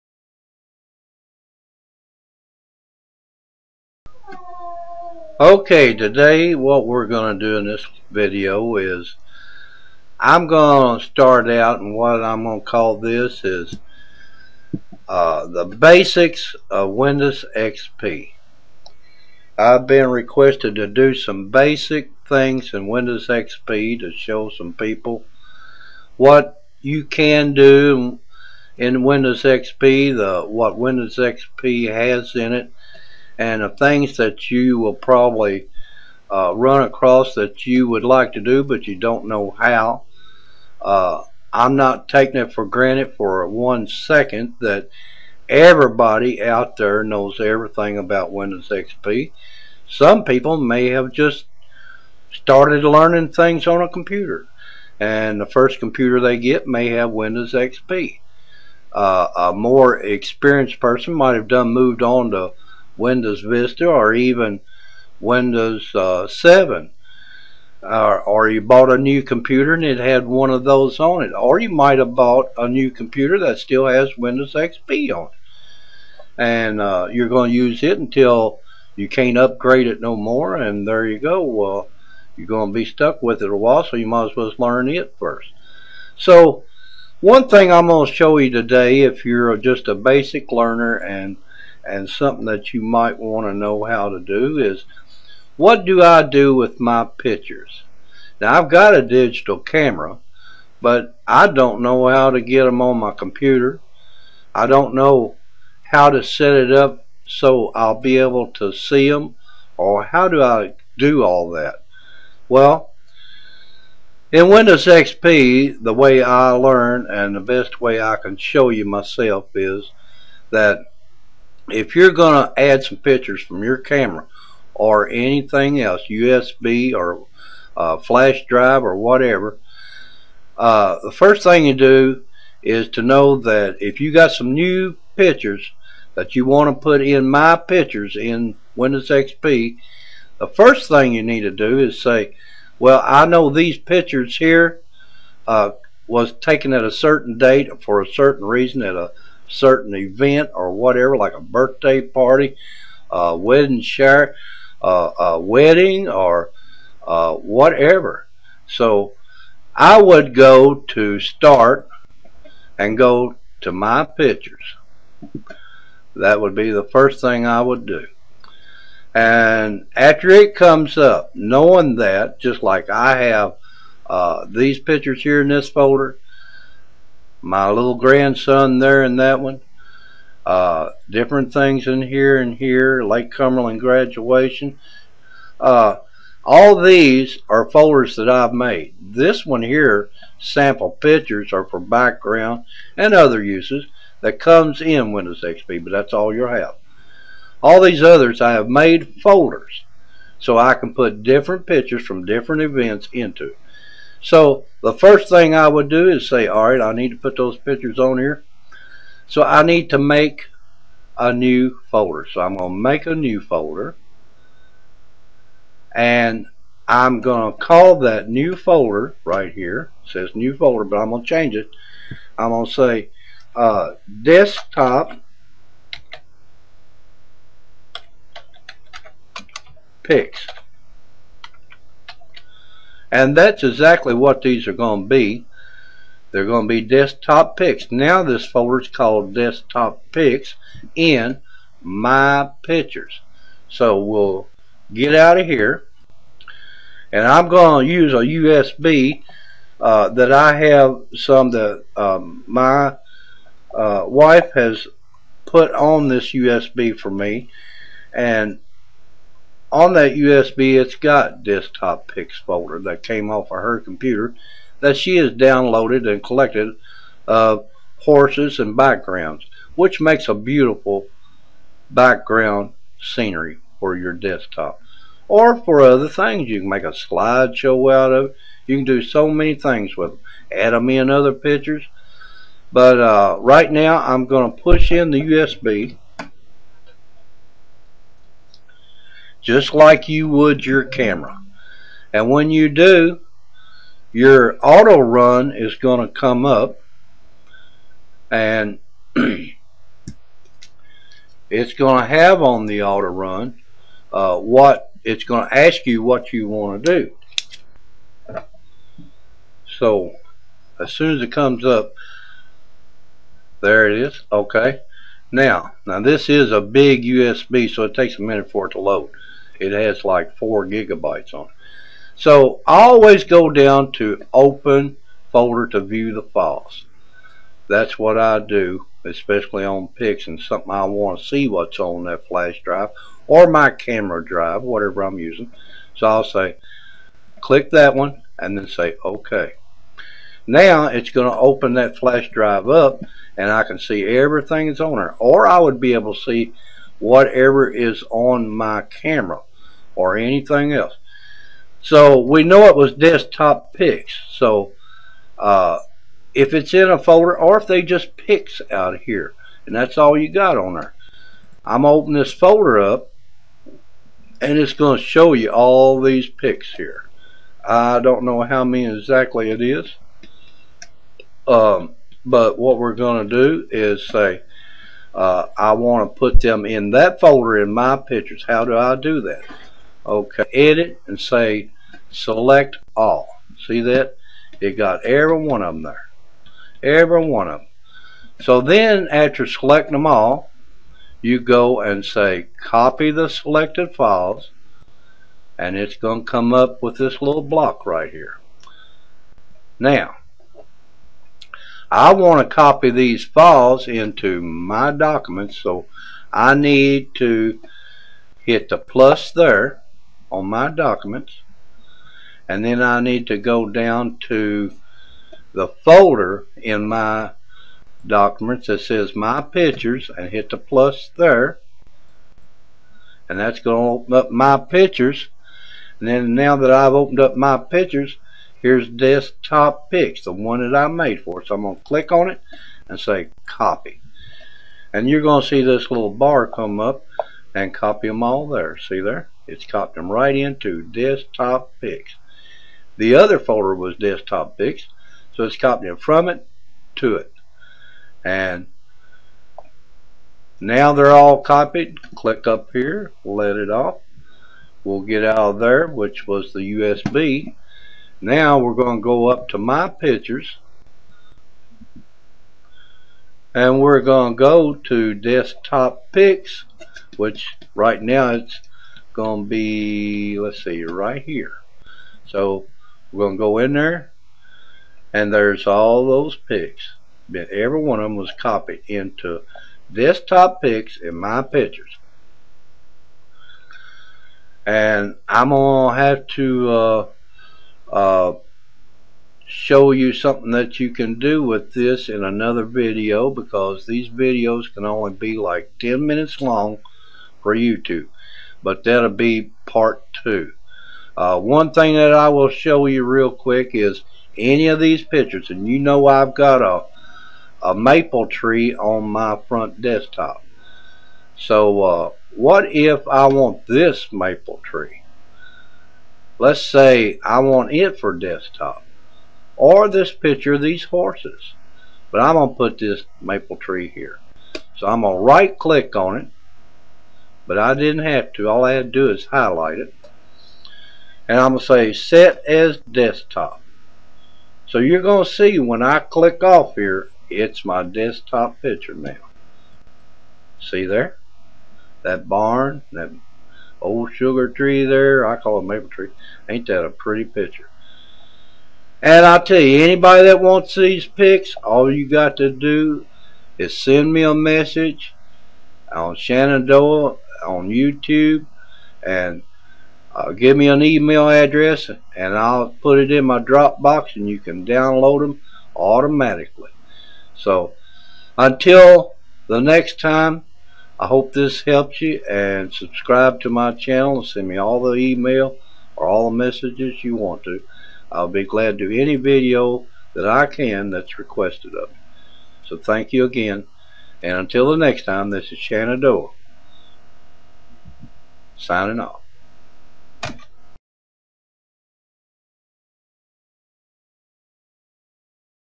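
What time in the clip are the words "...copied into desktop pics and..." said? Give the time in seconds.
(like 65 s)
478 s.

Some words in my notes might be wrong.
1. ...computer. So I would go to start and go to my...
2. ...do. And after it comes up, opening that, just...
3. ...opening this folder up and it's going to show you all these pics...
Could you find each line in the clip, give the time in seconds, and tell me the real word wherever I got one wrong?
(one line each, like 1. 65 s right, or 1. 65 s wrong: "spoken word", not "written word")
1. 157 s wrong: "whatever", not "computer"
2. 167 s wrong: "knowing", not "opening"
3. 361 s right.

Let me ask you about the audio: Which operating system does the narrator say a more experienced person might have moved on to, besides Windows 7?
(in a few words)
Windows Vista.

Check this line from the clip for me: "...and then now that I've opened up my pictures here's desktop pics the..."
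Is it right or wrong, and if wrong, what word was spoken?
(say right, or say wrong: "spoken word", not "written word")
right.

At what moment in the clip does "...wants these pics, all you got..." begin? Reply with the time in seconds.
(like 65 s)
550 s.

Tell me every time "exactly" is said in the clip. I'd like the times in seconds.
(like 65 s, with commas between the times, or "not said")
233 s, 368 s.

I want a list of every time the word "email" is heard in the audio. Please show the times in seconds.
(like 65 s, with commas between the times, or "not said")
560 s, 574 s.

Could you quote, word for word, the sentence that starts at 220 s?
It says new folder, but I'm going to change it.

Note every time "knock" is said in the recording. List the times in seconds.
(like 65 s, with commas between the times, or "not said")
not said.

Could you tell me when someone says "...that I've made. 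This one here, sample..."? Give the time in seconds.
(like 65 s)
188 s.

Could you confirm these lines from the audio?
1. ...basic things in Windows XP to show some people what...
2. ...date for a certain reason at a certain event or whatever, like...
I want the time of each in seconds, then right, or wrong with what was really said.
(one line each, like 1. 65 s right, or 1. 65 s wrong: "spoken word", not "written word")
1. 21 s right
2. 147 s right.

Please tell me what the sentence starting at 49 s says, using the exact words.
Some people may have just started learning things on a computer and the first computer they get may have Windows XP.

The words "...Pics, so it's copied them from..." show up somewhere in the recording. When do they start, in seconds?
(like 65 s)
444 s.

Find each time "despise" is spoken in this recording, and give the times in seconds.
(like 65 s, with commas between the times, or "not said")
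not said.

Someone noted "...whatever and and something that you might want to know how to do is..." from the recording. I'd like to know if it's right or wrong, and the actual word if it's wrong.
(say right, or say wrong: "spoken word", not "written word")
wrong: "learner", not "whatever".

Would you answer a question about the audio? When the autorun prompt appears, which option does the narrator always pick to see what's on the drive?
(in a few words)
open folder to view the files.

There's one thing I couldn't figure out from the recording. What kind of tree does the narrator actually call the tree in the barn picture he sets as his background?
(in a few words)
sugar tree.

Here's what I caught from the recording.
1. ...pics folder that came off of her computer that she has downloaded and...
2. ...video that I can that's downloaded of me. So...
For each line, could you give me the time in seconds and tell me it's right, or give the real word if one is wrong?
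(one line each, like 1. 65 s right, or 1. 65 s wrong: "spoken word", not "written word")
1. 262 s right
2. 579 s wrong: "requested", not "downloaded".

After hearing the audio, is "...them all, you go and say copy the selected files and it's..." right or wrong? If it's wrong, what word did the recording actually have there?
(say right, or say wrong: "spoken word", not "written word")
right.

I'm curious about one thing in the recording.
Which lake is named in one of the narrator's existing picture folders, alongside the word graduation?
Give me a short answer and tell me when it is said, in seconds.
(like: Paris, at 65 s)
Lake Cumberland, at 183 s.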